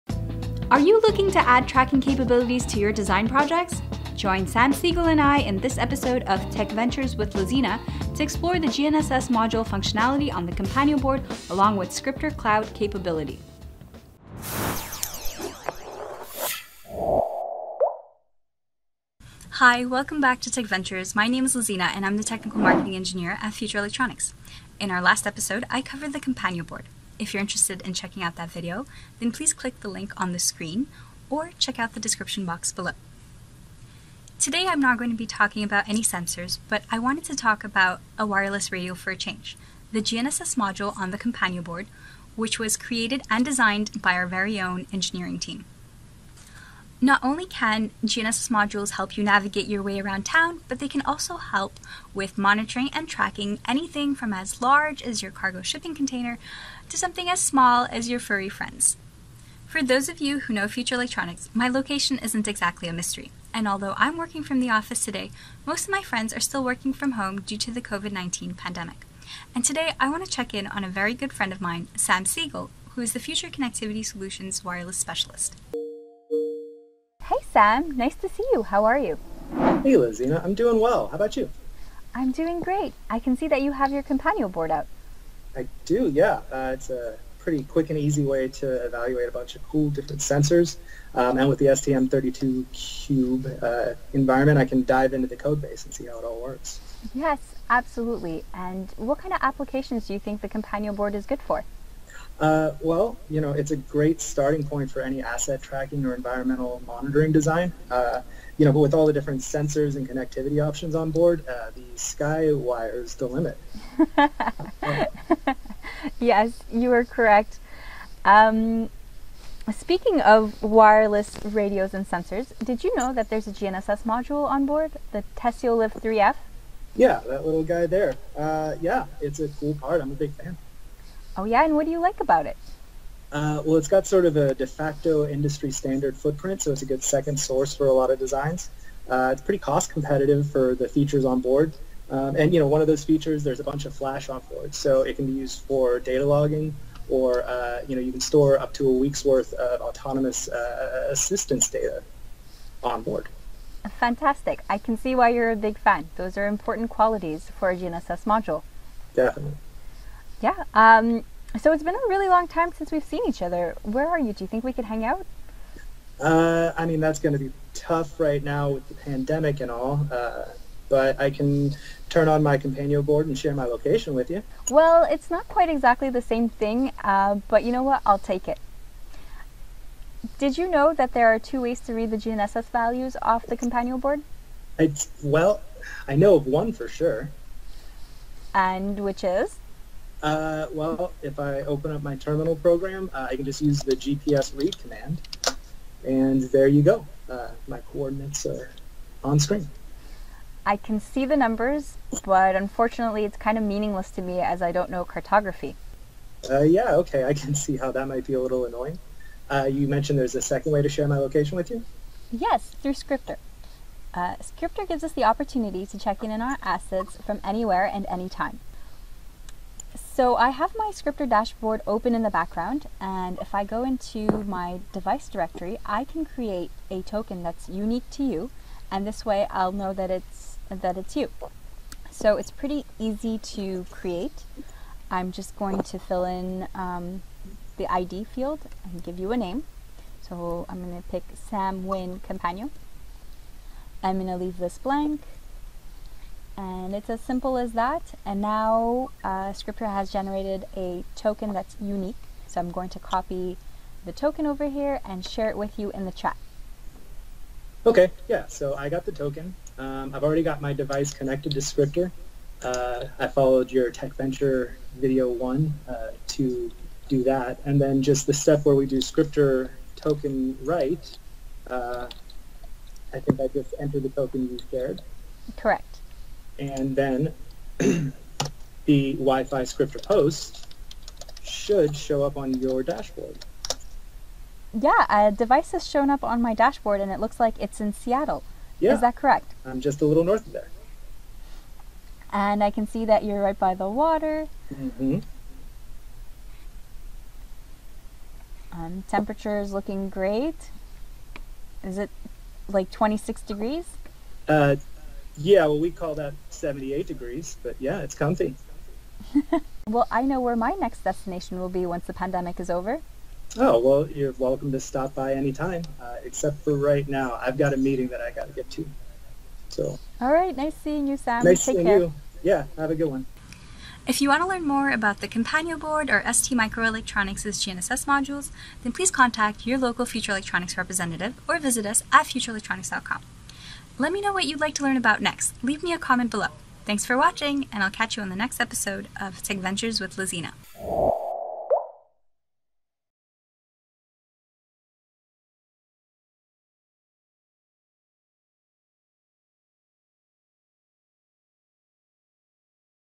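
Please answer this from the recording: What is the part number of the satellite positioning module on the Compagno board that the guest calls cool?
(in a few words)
Teseo-LIV3F.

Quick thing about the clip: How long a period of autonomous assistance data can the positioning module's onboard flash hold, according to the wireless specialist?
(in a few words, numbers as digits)
a week.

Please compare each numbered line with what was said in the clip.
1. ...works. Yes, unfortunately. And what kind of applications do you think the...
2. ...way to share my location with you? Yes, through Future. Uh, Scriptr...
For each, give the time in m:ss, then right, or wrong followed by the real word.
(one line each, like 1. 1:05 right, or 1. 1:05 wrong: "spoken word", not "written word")
1. 1:36 wrong: "absolutely", not "unfortunately"
2. 3:30 wrong: "Scriptr", not "Future".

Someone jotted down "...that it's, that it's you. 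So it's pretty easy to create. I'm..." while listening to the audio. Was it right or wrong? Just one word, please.
right.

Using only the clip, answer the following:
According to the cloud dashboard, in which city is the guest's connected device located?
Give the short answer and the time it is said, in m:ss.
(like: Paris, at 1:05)
Seattle, at 4:47.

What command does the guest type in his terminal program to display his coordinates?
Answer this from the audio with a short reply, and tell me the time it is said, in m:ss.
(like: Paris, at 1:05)
GPS read, at 3:13.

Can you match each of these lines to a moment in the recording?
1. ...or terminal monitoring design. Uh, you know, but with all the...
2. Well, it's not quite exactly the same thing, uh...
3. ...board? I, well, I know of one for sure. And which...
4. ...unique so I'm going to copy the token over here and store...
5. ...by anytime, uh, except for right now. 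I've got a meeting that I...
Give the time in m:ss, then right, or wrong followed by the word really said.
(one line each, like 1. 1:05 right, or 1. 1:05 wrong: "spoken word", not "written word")
1. 1:46 wrong: "environmental", not "terminal"
2. 2:54 right
3. 3:03 right
4. 4:11 wrong: "share", not "store"
5. 5:15 right.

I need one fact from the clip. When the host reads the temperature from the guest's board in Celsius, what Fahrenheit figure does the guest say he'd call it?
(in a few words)
78 degrees.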